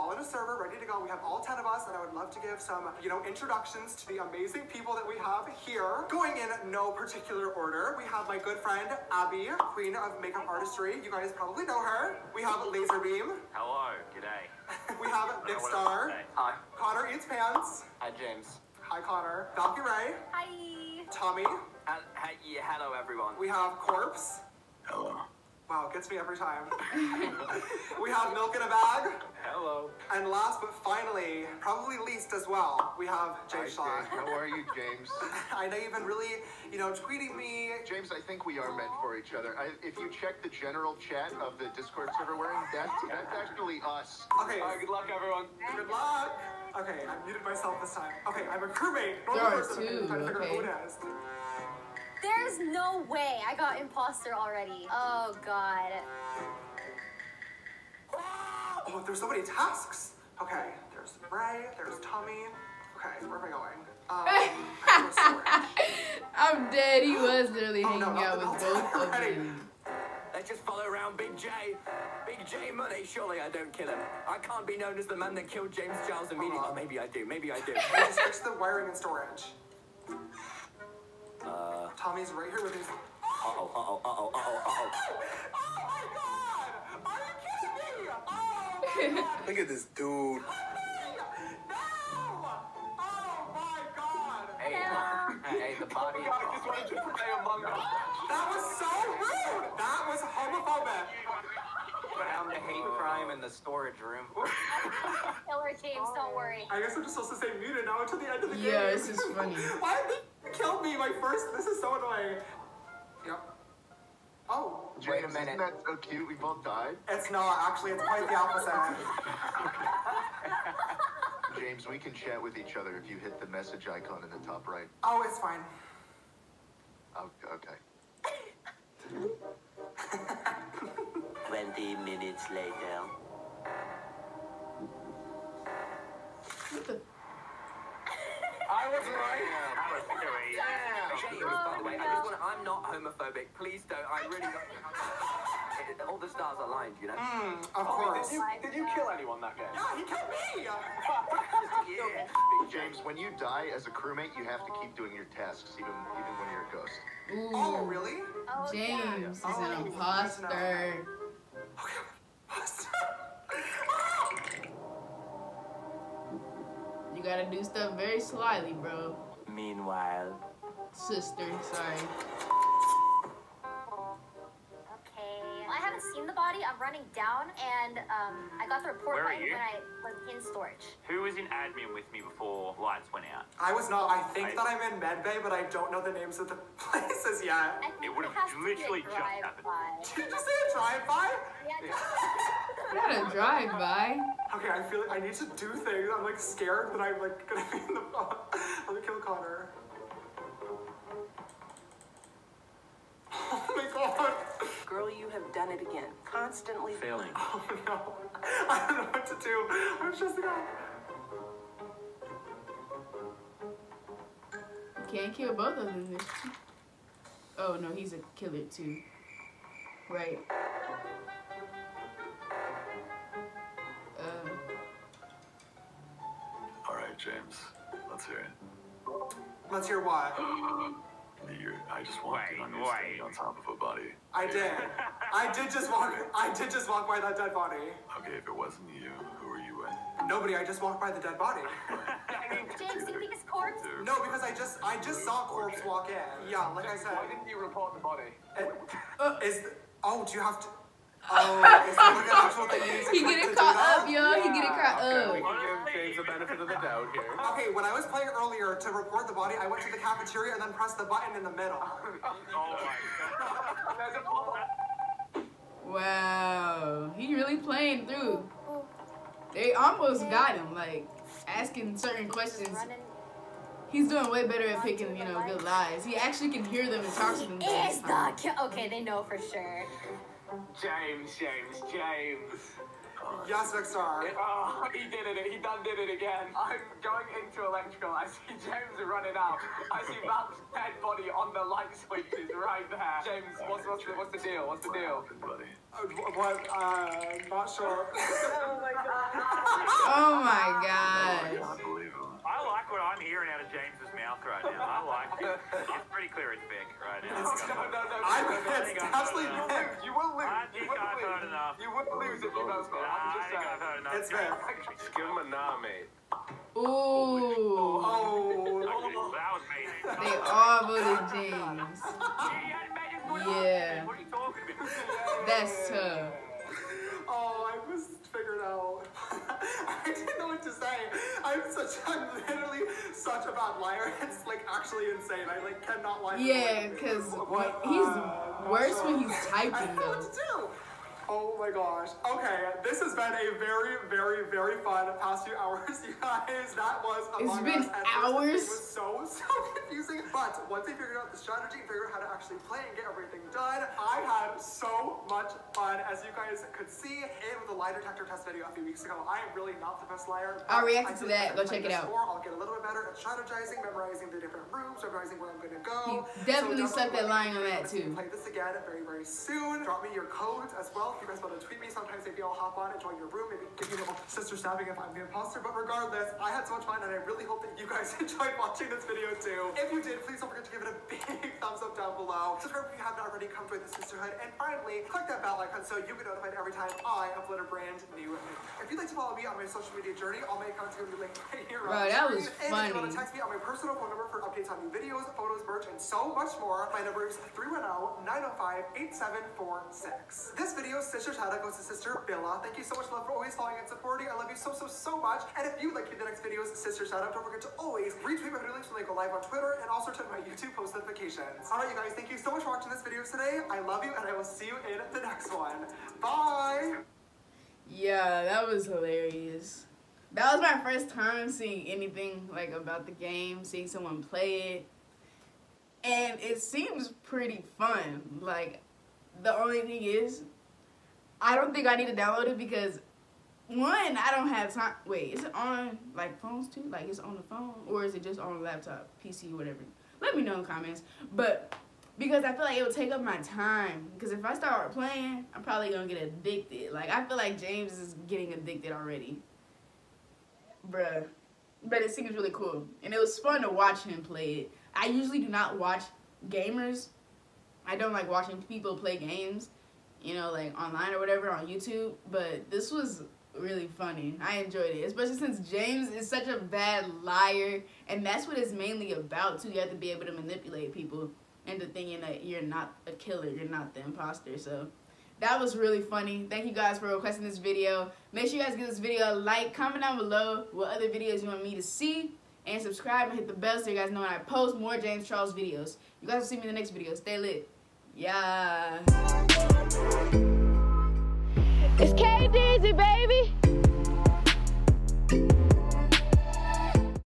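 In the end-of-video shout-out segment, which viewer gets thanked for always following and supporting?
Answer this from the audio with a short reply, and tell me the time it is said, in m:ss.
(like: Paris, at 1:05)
Sister Billa, at 6:41.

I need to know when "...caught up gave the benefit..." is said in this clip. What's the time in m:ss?
4:14.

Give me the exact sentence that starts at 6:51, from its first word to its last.
All right, you guys, thank you so much for watching this video today.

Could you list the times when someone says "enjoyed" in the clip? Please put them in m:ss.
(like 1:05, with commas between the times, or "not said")
6:18, 7:44.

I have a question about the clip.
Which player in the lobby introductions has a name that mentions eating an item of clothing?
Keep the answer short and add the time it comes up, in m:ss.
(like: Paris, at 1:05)
Connor Eats Pants, at 0:16.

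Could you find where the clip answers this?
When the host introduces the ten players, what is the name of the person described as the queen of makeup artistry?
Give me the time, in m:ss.
0:09.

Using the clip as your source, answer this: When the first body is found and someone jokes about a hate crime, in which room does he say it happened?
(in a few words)
storage room.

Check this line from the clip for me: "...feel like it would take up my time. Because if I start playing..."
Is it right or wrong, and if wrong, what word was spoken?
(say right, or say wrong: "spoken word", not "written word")
right.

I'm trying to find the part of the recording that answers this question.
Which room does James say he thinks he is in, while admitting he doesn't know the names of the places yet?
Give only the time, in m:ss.
3:04.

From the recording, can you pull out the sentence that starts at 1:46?
I guess I'm just supposed to say muted now until the end of the yeah, game.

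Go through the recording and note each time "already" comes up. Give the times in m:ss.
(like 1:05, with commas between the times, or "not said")
0:54, 6:23, 7:28.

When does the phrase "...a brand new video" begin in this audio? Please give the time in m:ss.
6:27.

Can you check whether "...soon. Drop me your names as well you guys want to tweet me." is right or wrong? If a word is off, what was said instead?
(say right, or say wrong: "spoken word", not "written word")
wrong: "codes", not "names".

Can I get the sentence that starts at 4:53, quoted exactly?
James, what's, what's, the, what's the deal?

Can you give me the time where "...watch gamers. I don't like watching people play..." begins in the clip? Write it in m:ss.
7:35.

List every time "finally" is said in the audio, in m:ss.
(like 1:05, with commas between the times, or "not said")
0:30, 6:24.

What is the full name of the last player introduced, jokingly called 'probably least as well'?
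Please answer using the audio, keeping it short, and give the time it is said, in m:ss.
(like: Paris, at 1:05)
James Shaw, at 0:33.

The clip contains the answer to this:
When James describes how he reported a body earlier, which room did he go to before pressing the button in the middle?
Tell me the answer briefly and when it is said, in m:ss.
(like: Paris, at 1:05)
the cafeteria, at 4:19.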